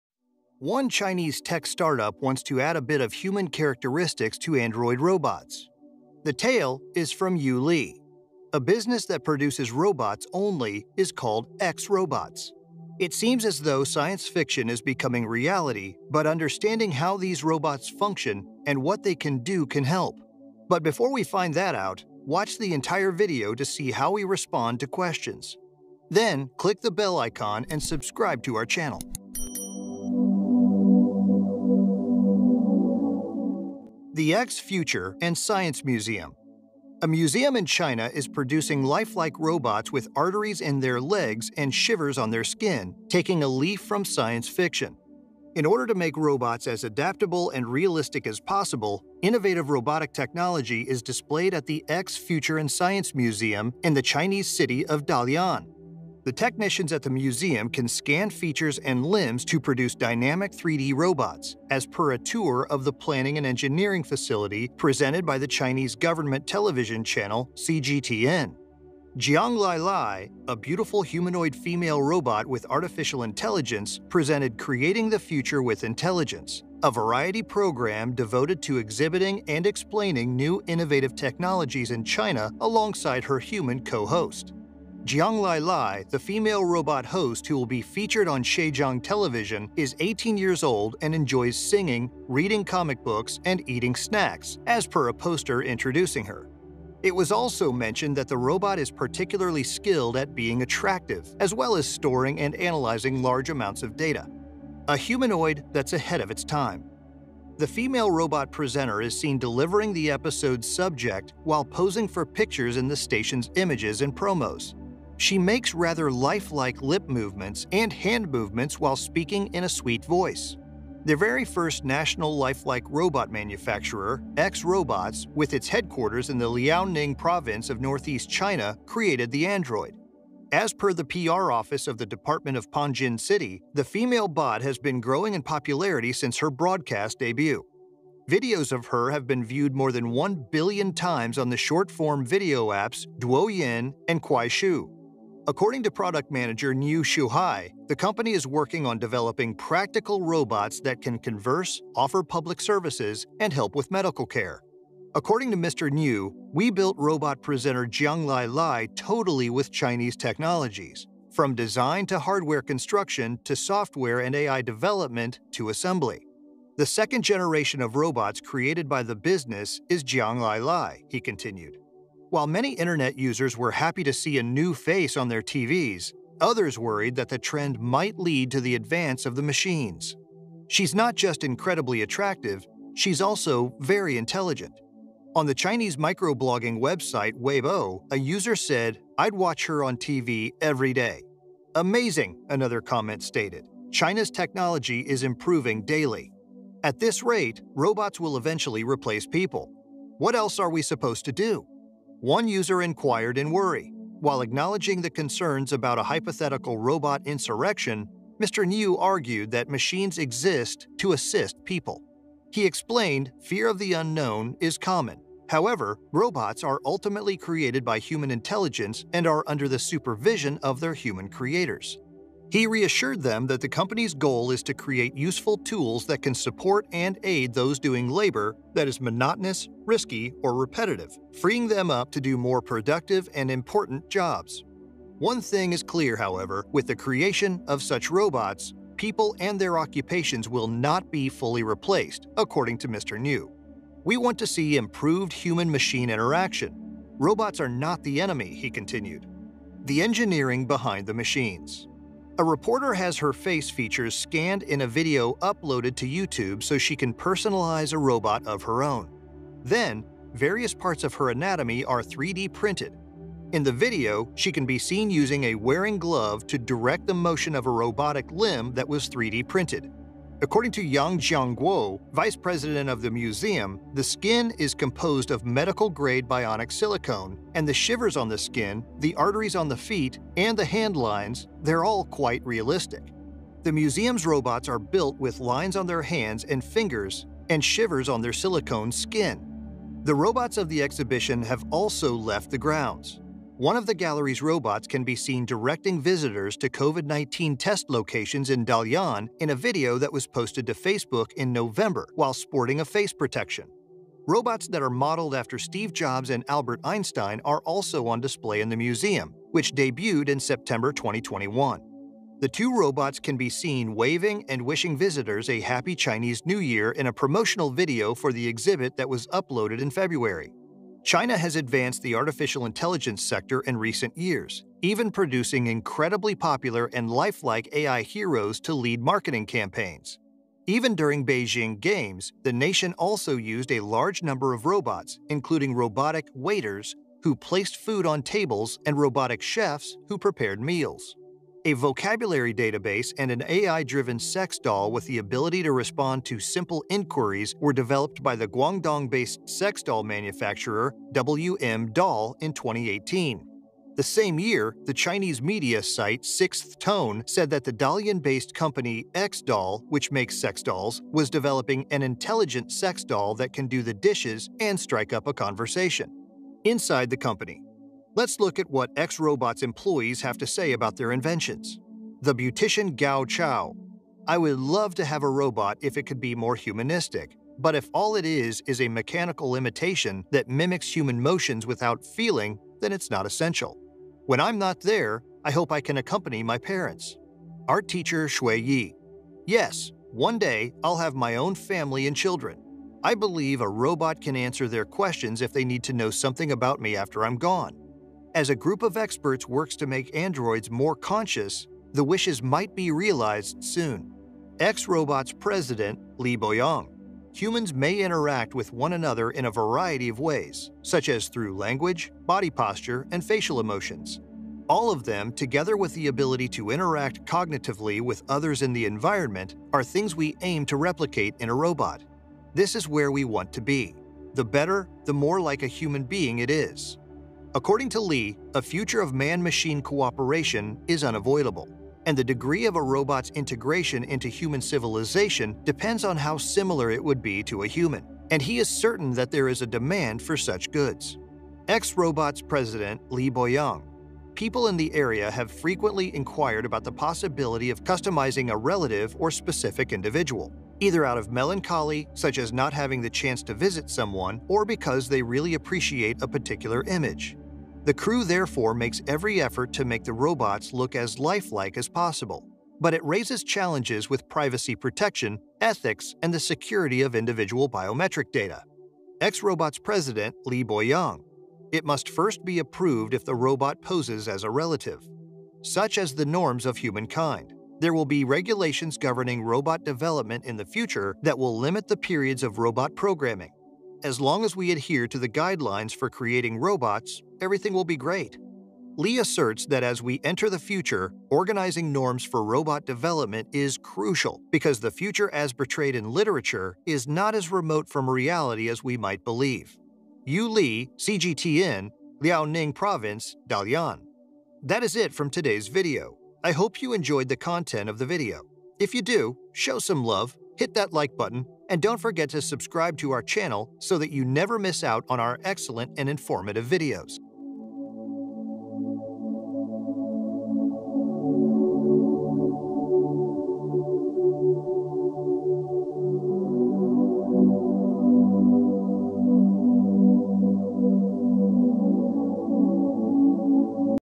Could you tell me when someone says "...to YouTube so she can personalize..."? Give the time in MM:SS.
04:15.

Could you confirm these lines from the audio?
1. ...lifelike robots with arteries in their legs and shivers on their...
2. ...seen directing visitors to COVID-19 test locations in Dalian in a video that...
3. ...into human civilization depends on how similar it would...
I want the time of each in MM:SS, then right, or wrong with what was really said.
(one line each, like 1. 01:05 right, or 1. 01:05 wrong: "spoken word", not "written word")
1. 00:38 right
2. 04:55 right
3. 07:14 right.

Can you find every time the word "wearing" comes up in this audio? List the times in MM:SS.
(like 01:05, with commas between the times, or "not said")
04:25.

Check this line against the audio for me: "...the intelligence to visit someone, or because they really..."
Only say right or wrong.
wrong.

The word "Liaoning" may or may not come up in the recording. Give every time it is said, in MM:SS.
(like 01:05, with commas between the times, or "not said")
02:06, 08:22.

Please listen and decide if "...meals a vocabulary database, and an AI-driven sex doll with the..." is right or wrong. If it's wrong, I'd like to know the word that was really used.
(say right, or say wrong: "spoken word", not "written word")
right.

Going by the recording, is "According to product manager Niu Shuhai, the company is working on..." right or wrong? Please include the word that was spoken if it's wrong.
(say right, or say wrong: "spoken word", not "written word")
right.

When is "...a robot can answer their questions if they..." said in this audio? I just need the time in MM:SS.
06:33.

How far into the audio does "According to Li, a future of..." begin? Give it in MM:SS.
07:07.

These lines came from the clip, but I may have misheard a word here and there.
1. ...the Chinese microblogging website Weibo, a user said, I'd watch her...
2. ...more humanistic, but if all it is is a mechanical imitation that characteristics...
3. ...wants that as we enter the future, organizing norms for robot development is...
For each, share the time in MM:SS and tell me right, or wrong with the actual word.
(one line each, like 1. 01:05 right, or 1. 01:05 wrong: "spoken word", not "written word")
1. 03:05 right
2. 06:16 wrong: "mimics", not "characteristics"
3. 08:09 wrong: "asserts", not "wants".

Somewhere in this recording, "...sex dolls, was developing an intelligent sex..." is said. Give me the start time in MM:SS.
06:00.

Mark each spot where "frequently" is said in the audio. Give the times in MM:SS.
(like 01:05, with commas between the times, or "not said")
07:25.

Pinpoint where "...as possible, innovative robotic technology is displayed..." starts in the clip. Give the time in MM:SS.
00:48.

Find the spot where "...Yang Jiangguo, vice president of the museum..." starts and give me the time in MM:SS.
04:30.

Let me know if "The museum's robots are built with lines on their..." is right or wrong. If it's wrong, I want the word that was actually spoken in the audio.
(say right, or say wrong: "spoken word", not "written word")
right.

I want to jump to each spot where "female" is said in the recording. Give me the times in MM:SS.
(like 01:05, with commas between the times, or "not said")
01:11, 01:26, 01:47, 02:13.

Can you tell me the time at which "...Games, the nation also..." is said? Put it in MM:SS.
05:31.